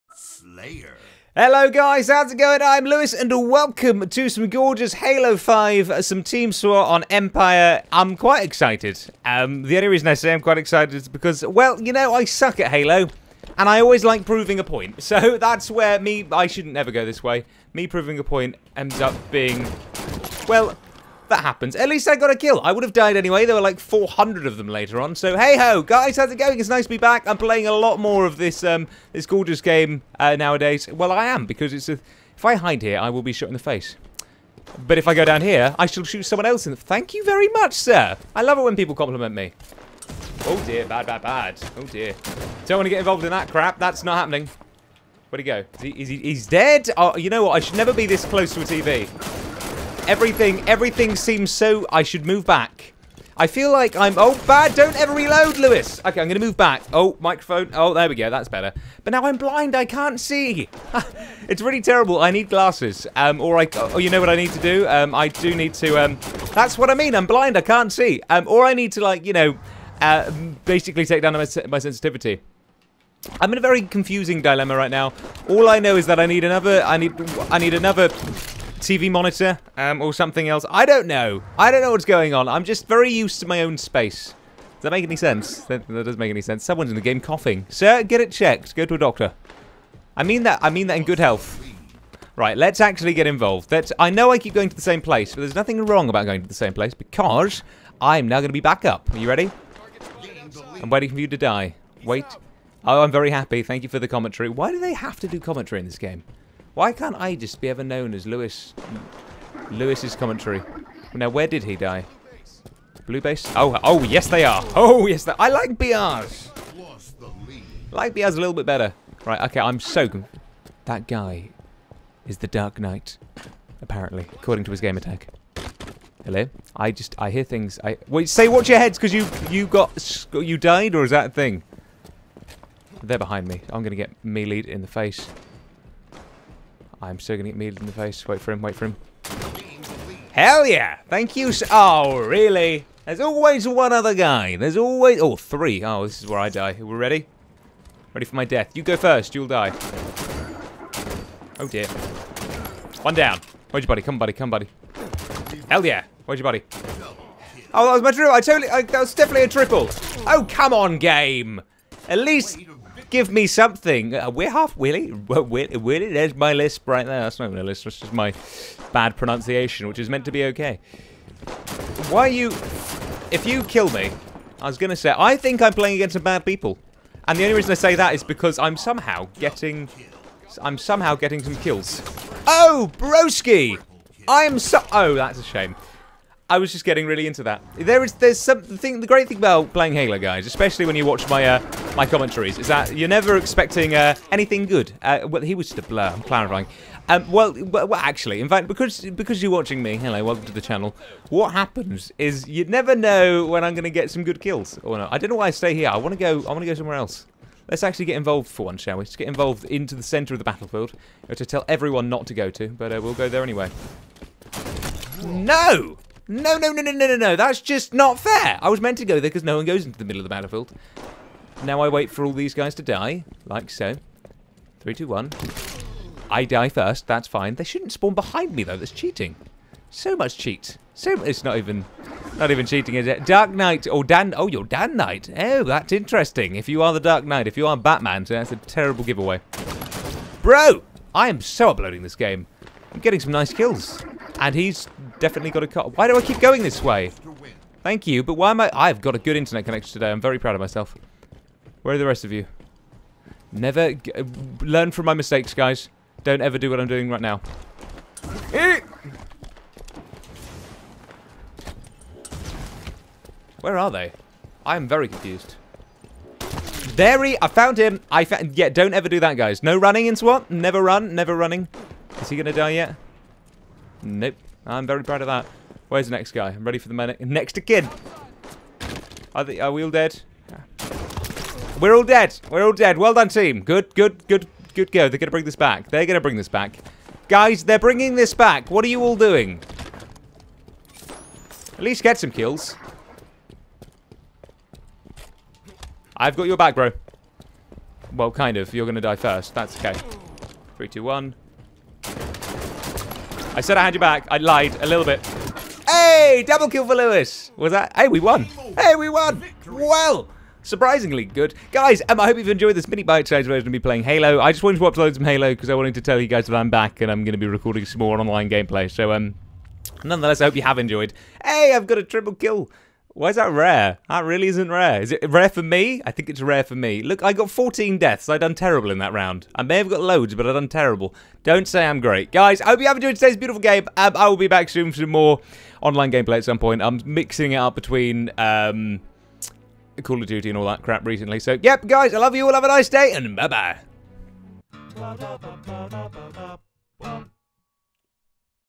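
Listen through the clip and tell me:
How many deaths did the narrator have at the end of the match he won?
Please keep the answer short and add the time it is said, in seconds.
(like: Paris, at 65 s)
14, at 327 s.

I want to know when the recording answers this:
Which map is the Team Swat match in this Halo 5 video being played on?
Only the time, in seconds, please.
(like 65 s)
7 s.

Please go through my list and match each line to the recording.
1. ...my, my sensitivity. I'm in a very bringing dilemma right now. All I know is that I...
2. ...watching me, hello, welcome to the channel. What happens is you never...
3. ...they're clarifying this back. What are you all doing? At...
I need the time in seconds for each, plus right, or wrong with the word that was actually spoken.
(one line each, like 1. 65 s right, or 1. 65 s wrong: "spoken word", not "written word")
1. 71 s wrong: "confusing", not "bringing"
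2. 199 s right
3. 287 s wrong: "bringing", not "clarifying".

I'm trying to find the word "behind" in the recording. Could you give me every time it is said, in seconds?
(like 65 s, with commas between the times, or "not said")
133 s, 228 s.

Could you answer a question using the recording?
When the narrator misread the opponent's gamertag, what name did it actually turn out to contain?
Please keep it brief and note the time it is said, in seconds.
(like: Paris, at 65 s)
Dan Knight, at 234 s.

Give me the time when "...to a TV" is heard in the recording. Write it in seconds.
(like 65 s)
48 s.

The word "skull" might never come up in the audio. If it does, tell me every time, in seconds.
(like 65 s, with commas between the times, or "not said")
not said.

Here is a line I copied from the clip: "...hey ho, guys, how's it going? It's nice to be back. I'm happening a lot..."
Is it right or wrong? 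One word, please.
wrong.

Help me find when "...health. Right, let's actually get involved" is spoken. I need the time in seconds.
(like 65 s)
91 s.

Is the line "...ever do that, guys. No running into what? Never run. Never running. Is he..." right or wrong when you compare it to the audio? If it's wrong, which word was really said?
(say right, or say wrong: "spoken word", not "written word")
right.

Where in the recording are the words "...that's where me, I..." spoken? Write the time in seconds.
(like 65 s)
15 s.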